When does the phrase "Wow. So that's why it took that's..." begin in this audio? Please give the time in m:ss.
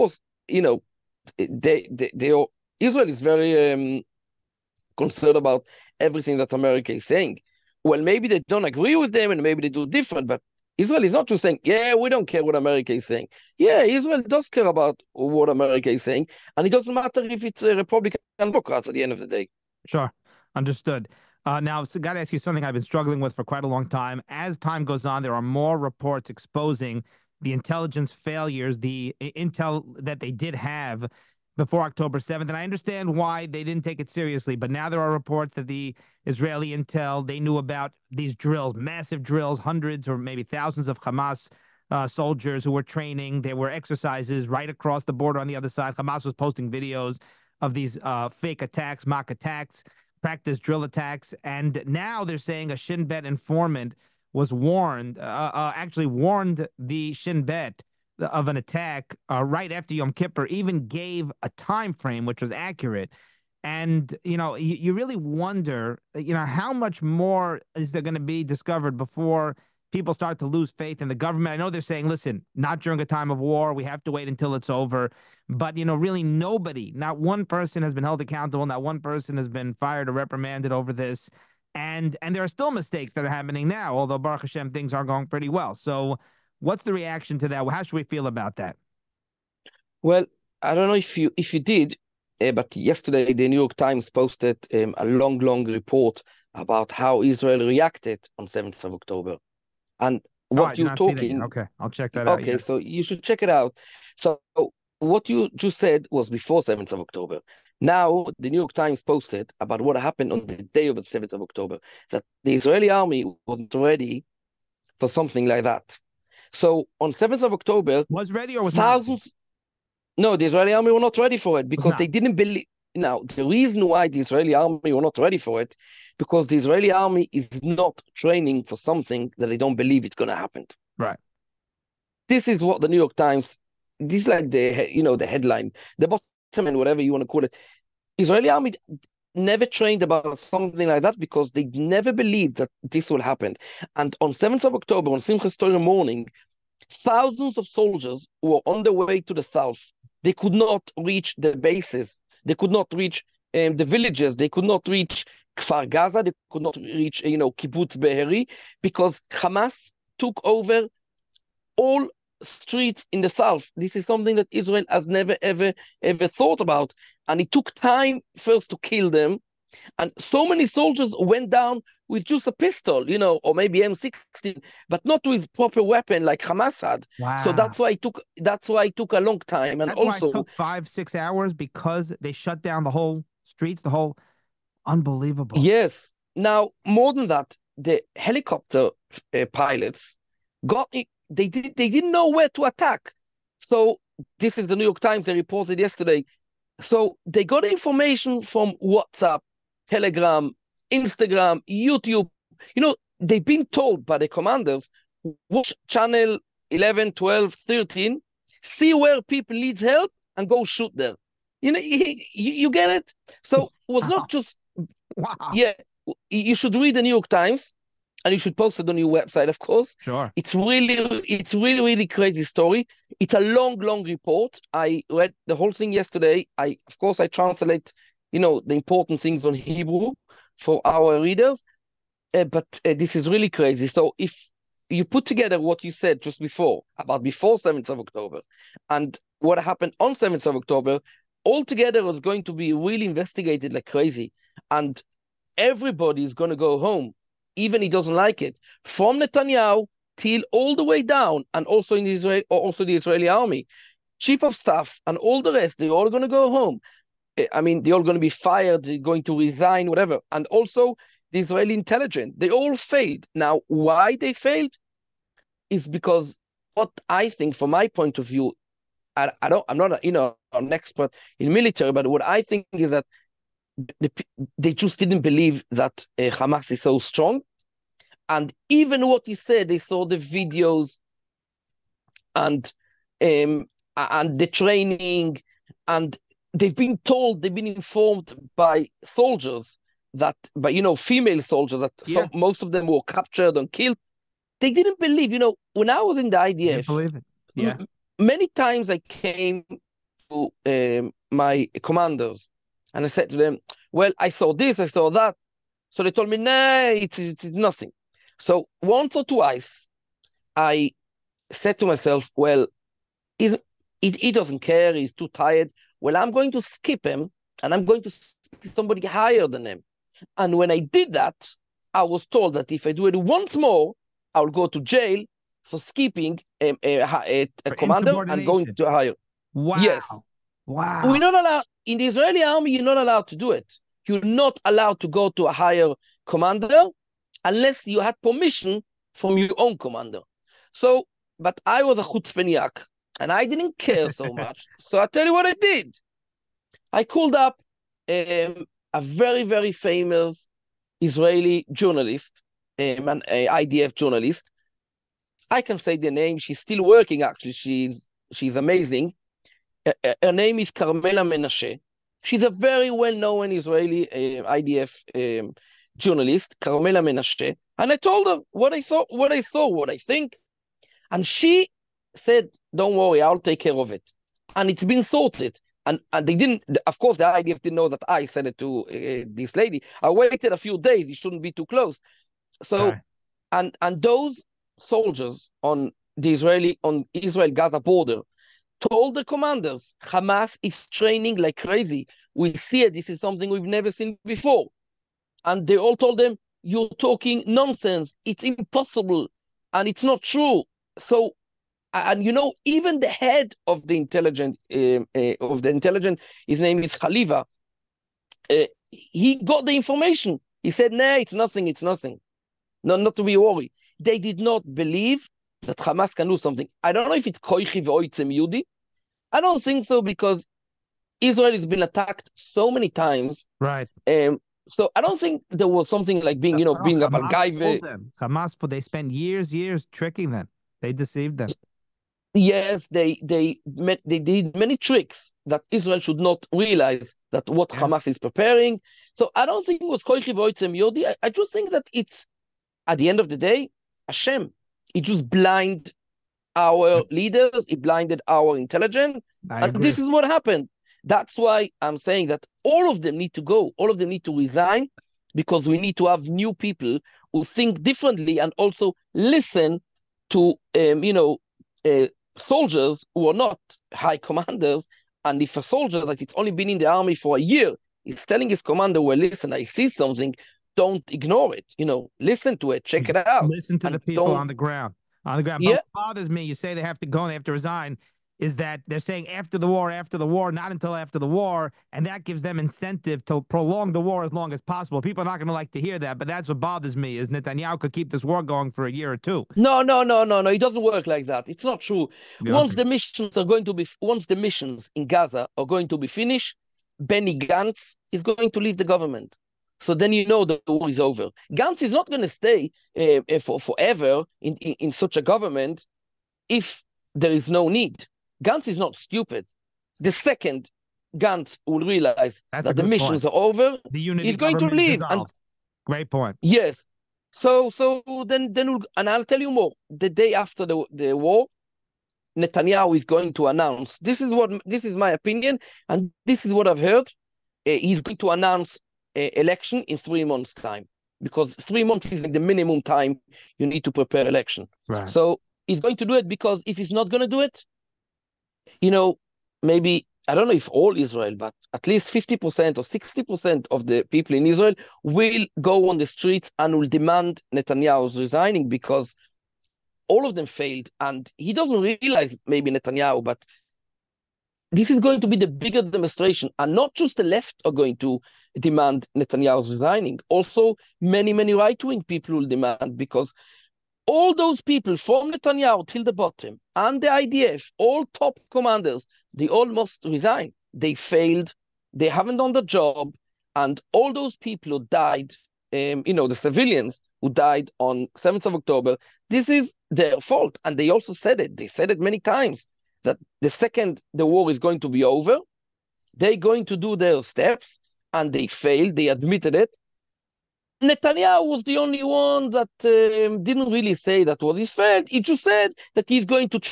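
2:57.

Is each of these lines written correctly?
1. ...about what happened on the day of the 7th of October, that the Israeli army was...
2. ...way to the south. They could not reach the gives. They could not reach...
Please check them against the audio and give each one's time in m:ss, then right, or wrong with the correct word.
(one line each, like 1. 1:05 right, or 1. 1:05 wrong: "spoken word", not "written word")
1. 1:49 right
2. 2:28 wrong: "bases", not "gives".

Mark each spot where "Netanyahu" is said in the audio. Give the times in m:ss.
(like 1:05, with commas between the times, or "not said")
4:09, 8:07, 8:42, 9:07, 9:12, 9:19, 9:25, 9:50.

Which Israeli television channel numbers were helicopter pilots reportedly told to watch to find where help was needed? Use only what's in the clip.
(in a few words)
11, 12, 13.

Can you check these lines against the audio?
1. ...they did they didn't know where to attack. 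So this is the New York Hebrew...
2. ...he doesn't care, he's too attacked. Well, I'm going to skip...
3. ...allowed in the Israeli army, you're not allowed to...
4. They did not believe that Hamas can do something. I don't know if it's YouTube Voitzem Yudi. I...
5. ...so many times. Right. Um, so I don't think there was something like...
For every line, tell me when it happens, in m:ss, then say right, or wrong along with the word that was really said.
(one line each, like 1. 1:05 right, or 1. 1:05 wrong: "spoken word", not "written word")
1. 3:11 wrong: "Times", not "Hebrew"
2. 5:13 wrong: "tired", not "attacked"
3. 5:31 right
4. 6:53 wrong: "Koichi", not "YouTube"
5. 7:02 right.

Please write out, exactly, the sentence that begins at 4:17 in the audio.
Eh, I mean, they're all going to be fired, they're going to resign, whatever.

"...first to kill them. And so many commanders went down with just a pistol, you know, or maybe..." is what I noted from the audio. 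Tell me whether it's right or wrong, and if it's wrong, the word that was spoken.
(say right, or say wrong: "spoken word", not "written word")
wrong: "soldiers", not "commanders".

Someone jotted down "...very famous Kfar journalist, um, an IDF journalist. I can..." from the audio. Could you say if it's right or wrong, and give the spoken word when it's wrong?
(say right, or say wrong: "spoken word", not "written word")
wrong: "Israeli", not "Kfar".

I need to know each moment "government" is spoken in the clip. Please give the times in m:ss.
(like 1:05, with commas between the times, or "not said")
1:11, 8:18, 8:25.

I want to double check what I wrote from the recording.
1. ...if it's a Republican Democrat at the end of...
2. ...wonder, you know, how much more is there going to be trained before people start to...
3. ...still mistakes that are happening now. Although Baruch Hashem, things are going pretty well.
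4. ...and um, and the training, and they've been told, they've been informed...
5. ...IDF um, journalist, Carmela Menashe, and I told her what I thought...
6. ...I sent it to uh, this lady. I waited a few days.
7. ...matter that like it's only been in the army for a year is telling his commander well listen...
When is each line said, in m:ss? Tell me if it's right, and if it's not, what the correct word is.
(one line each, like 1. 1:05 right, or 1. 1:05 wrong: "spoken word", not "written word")
1. 0:17 right
2. 1:05 wrong: "discovered", not "trained"
3. 1:22 right
4. 4:42 right
5. 6:04 right
6. 6:18 right
7. 7:45 wrong: "soldier", not "matter".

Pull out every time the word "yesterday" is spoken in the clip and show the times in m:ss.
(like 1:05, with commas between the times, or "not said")
1:32, 3:15, 3:45.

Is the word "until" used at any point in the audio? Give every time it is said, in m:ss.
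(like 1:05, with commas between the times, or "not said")
1:14, 8:00.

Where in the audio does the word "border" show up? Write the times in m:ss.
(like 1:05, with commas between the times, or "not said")
0:45, 6:27.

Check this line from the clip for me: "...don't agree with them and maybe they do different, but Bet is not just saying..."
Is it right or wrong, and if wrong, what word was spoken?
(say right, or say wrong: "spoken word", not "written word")
wrong: "Israel", not "Bet".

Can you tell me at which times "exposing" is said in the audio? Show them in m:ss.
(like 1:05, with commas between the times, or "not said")
0:26.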